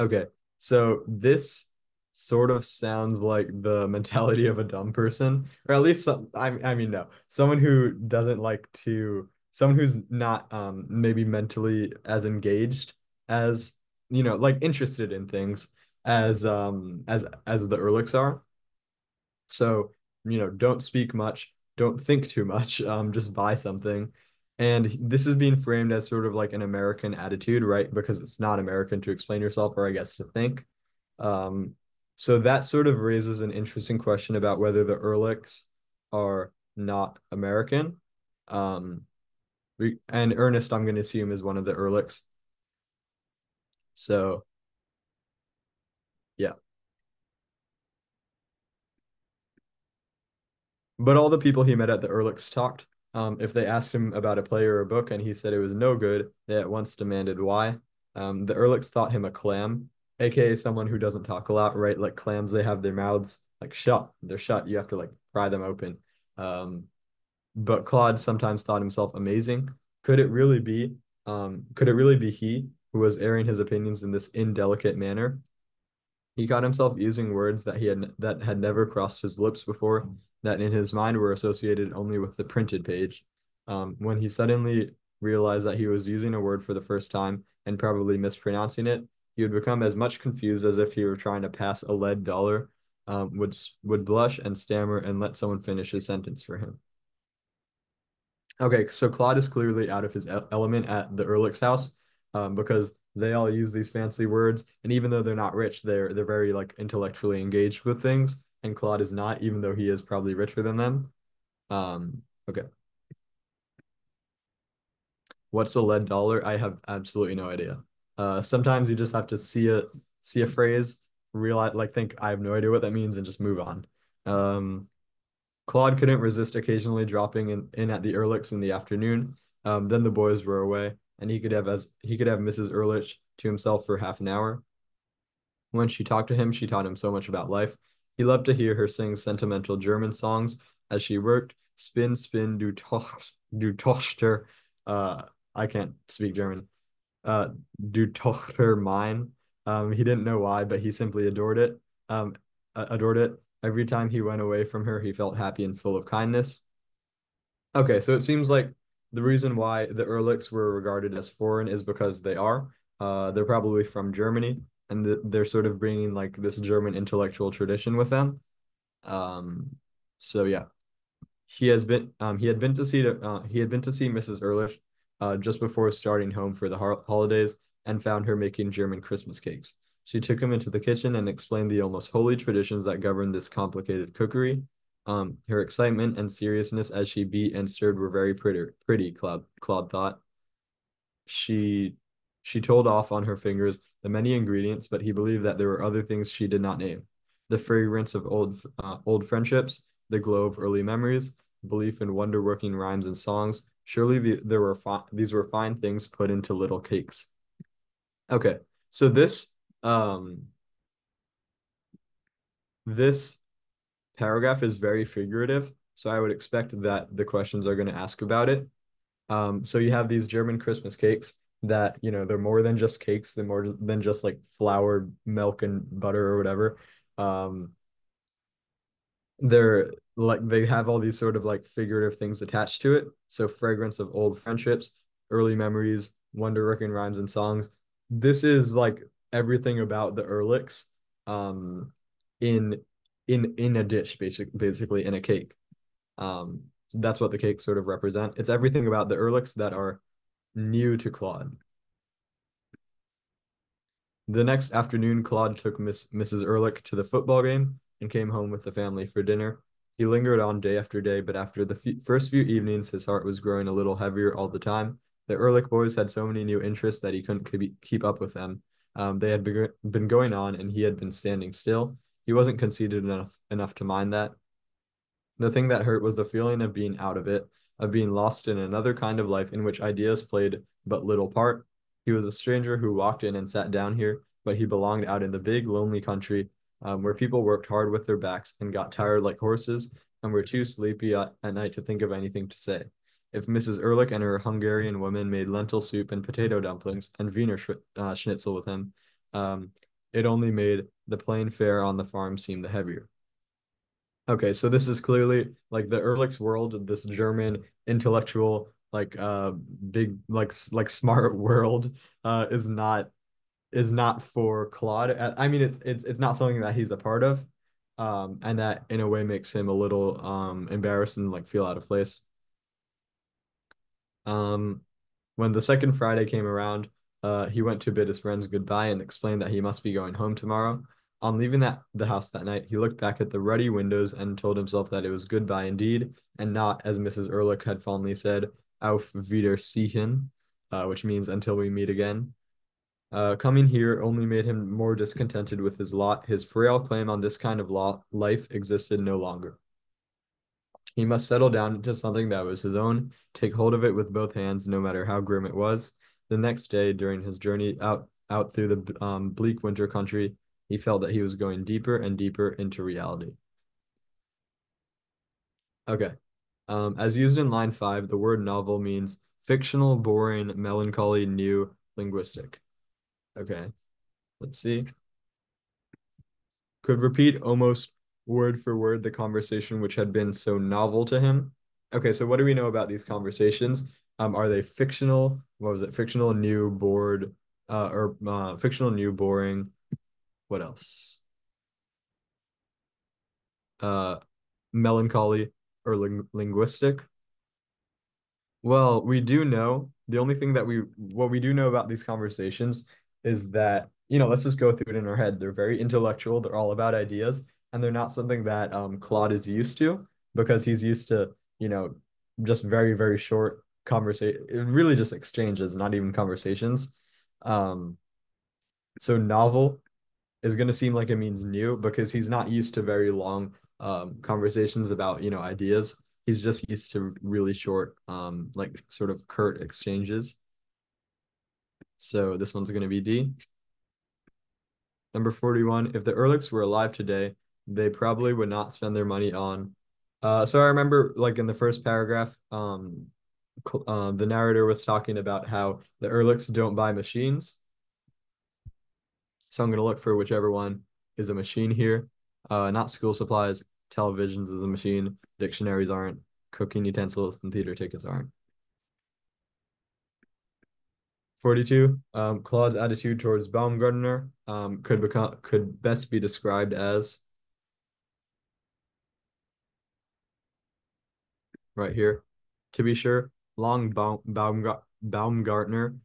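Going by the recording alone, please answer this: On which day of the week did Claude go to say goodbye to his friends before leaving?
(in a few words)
Friday.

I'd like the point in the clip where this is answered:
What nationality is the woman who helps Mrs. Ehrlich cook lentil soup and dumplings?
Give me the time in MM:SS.
04:54.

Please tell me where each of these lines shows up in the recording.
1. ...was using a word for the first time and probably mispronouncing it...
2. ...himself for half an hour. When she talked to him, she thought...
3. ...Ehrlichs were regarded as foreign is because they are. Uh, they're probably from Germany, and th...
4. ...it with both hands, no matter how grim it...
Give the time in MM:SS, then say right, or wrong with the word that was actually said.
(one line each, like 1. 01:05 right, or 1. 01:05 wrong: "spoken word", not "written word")
1. 01:25 right
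2. 02:13 wrong: "taught", not "thought"
3. 02:40 right
4. 05:53 right.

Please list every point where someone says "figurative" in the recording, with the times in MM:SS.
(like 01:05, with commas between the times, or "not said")
03:35, 03:51.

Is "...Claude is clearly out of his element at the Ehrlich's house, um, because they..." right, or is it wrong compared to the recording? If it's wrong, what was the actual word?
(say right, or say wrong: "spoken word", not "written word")
right.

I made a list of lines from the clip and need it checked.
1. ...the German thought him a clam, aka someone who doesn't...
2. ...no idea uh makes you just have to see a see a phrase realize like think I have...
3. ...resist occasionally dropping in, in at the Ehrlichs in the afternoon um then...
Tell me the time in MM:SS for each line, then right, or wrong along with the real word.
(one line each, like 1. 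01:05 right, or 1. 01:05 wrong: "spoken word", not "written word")
1. 00:58 wrong: "Ehrlichs", not "German"
2. 01:57 wrong: "sometimes", not "makes"
3. 02:06 right.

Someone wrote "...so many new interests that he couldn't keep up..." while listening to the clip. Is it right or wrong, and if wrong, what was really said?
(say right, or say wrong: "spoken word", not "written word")
right.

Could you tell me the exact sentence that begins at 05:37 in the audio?
Erlich had fondly said, auf Wiedersehen, uh, which means until we meet again.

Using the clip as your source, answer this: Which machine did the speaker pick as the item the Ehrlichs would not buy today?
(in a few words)
Televisions.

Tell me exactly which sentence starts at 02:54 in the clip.
Ehrlich uh, just before starting home for the ho- holidays and found her making German Christmas cakes.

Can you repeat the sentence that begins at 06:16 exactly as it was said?
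Could repeat almost word for word the conversation which had been so novel to him.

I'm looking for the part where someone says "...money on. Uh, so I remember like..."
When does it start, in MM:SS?
07:19.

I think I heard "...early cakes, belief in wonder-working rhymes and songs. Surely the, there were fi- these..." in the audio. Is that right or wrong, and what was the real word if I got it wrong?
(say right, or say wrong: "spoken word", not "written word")
wrong: "memories", not "cakes".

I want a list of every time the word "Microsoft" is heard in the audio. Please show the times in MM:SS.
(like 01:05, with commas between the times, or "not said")
not said.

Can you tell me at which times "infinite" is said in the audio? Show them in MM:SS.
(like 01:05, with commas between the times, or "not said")
not said.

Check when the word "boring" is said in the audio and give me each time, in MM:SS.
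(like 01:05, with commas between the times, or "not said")
06:09, 06:29.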